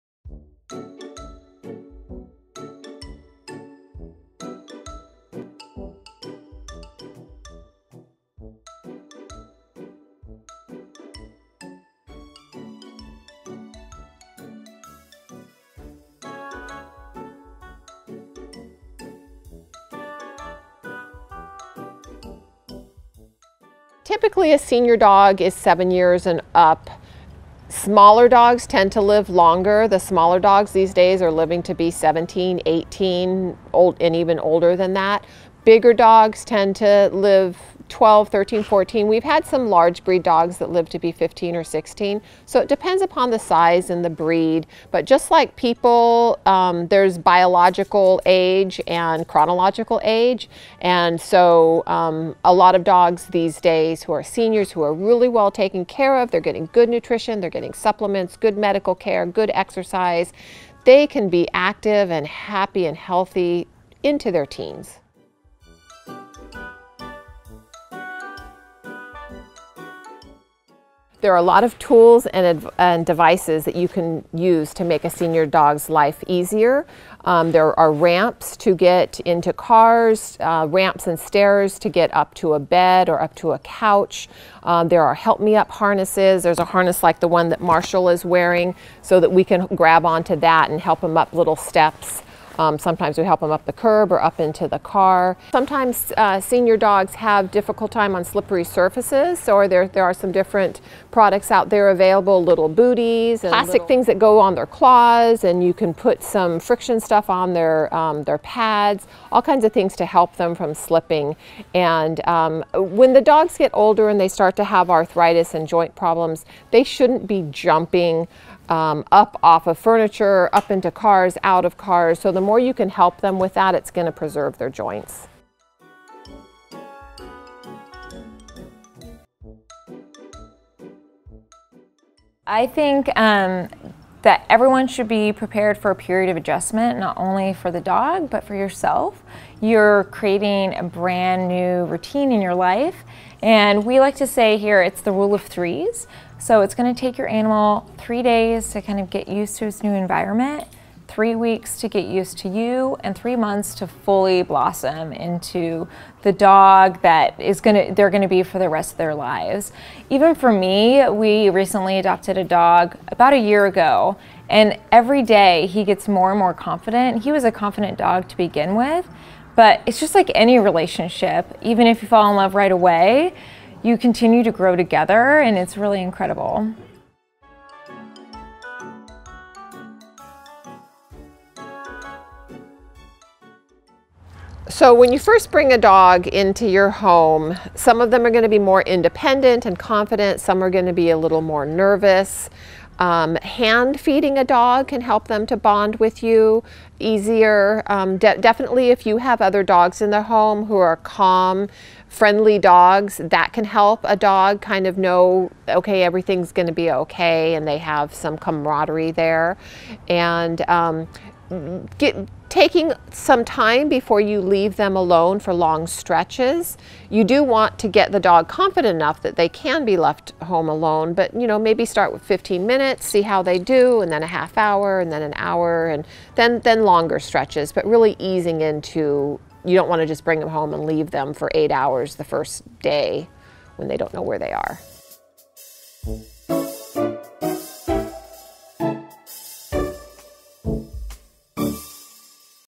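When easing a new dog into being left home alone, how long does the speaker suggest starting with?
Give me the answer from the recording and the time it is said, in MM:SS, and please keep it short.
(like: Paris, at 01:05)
15 minutes, at 03:42.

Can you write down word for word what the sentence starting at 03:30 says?
And um, get, taking some time before you leave them alone for long stretches.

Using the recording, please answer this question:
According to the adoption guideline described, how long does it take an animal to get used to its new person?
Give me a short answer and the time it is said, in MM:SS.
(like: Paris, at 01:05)
3 weeks, at 02:31.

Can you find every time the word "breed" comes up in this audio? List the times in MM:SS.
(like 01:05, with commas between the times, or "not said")
00:40, 00:44.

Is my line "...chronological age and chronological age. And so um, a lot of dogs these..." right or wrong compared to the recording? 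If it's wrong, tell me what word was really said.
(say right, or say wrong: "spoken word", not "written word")
wrong: "biological", not "chronological".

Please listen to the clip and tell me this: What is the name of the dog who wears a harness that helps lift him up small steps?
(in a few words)
Marshall.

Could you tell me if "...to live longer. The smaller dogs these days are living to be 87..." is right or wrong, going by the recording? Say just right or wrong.
wrong.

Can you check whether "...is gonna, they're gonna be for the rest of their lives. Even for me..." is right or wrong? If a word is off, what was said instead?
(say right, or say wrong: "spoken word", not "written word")
right.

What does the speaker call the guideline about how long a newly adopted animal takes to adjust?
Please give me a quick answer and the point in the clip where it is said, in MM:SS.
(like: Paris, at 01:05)
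rule of threes, at 02:25.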